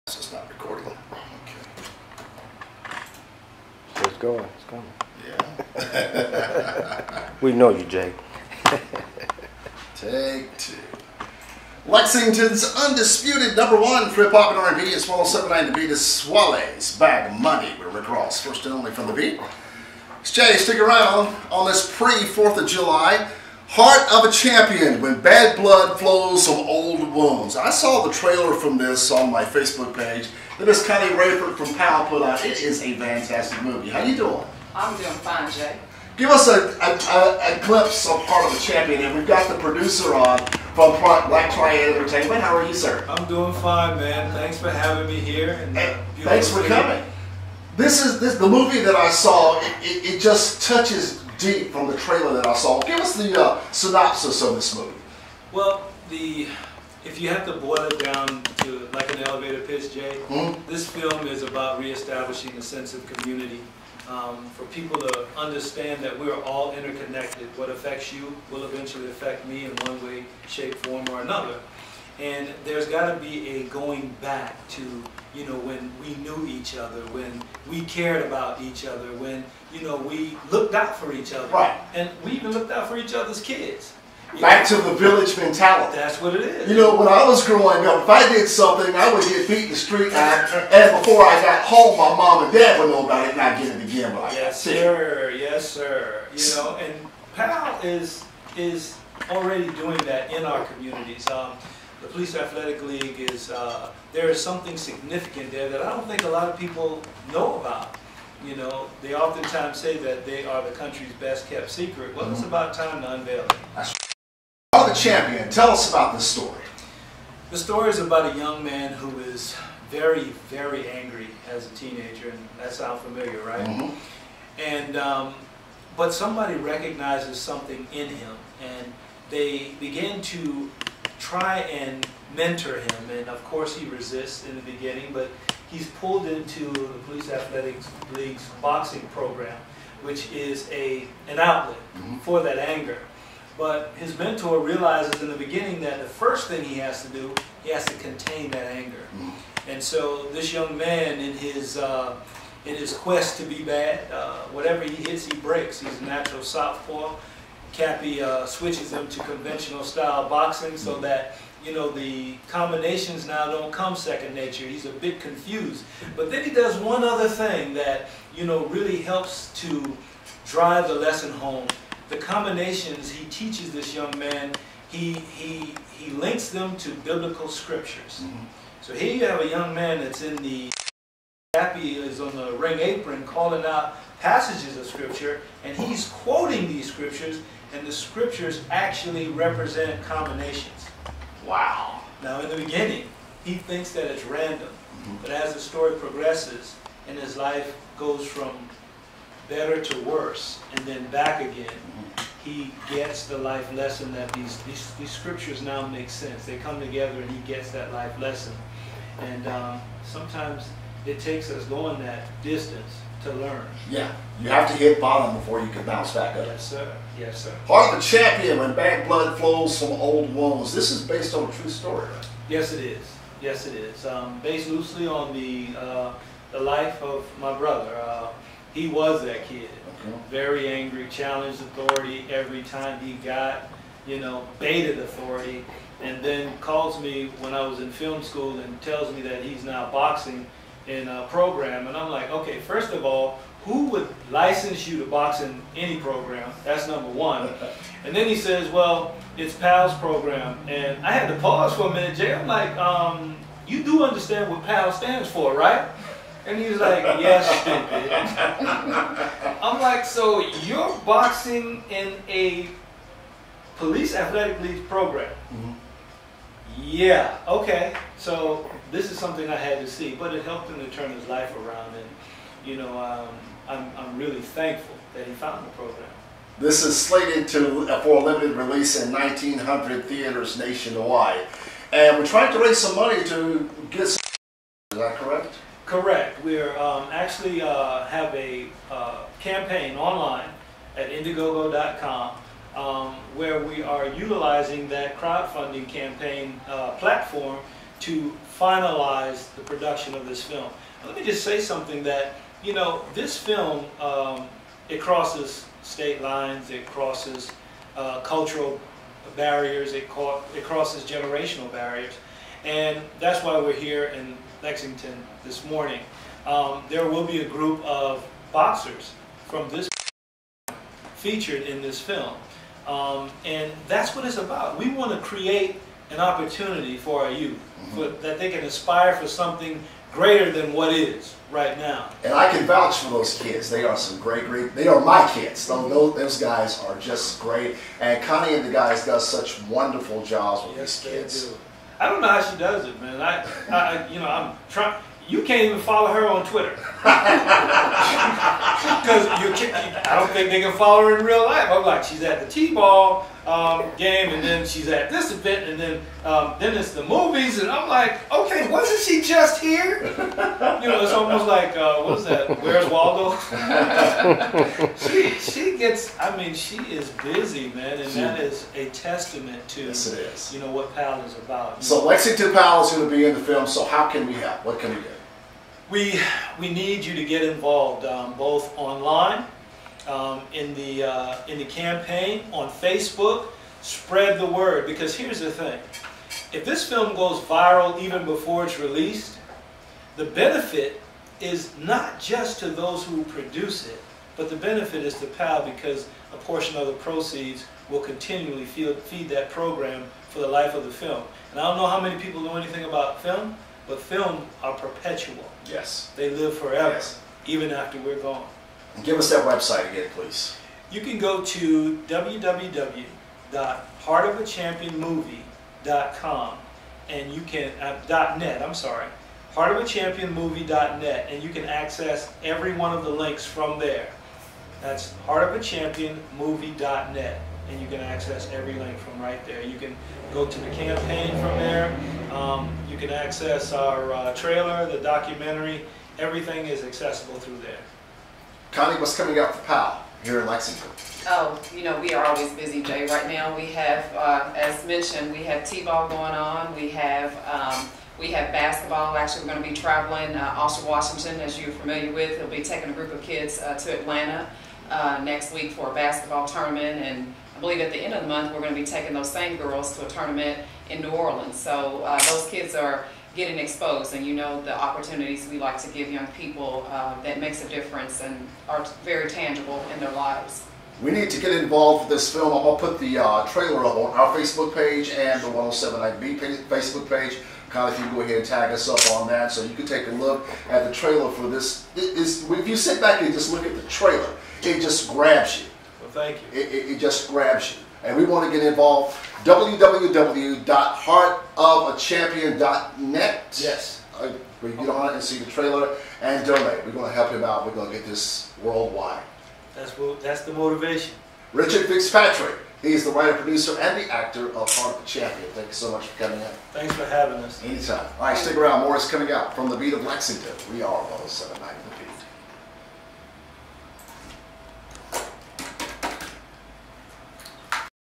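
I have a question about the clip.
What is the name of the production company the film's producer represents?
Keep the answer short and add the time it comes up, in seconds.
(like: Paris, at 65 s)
Black Triad Entertainment, at 41 s.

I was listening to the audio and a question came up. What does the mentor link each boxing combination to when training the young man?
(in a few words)
Biblical scriptures.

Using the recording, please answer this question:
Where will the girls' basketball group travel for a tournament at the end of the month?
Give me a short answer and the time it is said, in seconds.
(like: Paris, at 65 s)
New Orleans, at 461 s.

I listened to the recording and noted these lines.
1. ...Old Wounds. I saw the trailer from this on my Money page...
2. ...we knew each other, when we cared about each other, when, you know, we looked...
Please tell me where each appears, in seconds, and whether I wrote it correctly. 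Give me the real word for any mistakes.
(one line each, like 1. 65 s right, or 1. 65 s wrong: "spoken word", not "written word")
1. 26 s wrong: "Facebook", not "Money"
2. 76 s right.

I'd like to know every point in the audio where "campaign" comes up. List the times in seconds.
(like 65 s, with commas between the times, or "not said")
289 s, 295 s, 381 s, 430 s.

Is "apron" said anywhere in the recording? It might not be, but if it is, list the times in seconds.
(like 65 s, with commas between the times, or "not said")
182 s.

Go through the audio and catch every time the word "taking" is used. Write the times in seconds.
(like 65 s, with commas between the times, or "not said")
452 s, 458 s.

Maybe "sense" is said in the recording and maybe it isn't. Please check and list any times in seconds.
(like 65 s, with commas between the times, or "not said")
62 s, 206 s.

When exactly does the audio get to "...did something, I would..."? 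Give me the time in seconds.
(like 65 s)
88 s.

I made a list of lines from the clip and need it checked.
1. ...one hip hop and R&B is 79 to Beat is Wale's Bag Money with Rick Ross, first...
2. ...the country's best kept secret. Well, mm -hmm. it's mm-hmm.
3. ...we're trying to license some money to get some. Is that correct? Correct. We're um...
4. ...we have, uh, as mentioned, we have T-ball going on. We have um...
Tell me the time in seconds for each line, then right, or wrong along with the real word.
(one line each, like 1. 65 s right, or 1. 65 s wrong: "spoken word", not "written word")
1. 13 s right
2. 110 s right
3. 282 s wrong: "raise", not "license"
4. 443 s right.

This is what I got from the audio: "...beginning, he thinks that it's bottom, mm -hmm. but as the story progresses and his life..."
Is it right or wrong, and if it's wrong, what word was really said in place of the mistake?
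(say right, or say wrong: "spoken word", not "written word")
wrong: "random", not "bottom".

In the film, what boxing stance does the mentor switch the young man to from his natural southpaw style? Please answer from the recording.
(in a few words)
Conventional.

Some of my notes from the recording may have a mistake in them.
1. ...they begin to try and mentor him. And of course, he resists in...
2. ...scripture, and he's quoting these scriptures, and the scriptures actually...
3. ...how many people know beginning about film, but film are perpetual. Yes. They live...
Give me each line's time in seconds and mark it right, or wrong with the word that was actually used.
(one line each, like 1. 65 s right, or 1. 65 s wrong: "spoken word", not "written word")
1. 129 s right
2. 184 s right
3. 401 s wrong: "anything", not "beginning".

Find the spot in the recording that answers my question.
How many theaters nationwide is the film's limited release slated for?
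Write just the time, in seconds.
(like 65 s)
279 s.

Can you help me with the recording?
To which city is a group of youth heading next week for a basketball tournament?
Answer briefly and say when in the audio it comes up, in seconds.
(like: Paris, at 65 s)
Atlanta, at 453 s.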